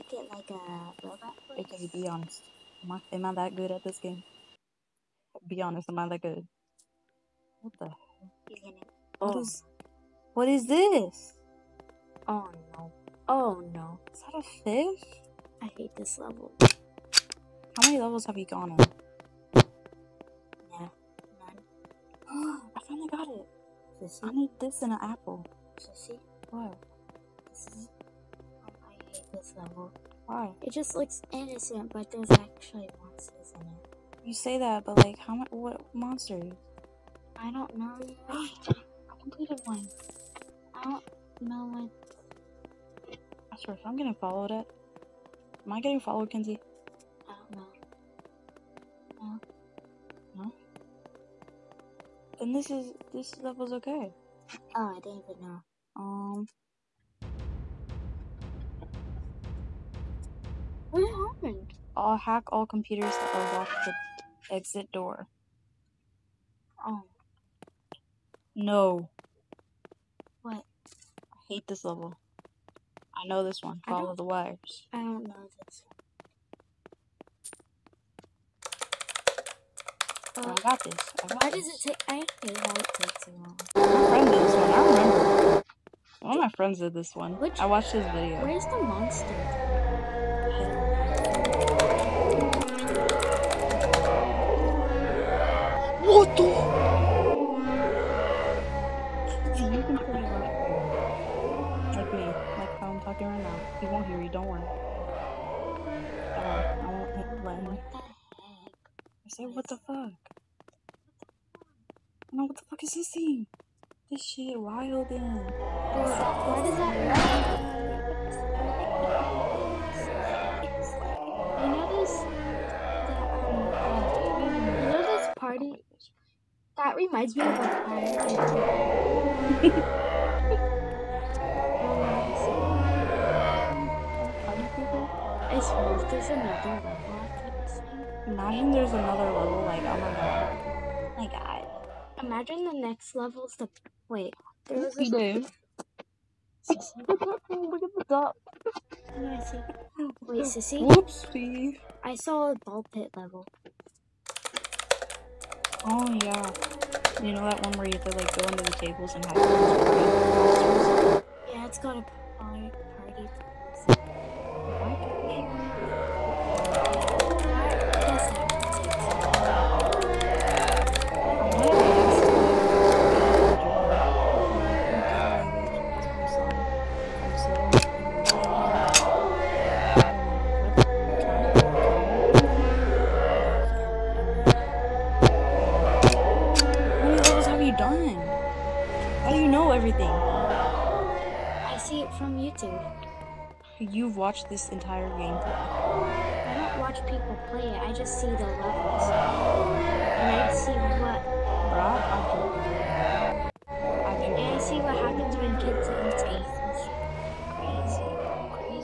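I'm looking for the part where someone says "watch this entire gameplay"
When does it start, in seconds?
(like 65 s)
194 s.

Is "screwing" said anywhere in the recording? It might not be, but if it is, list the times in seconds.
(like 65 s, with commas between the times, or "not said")
not said.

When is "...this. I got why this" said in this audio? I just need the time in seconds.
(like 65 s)
80 s.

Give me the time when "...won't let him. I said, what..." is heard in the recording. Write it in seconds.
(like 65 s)
106 s.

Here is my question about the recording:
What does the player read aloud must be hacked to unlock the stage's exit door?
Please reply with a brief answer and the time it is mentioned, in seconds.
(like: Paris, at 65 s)
all computers, at 62 s.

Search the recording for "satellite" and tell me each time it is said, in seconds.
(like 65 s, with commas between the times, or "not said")
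not said.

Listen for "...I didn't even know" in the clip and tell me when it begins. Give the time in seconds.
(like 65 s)
54 s.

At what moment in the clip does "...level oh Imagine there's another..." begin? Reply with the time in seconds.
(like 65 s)
136 s.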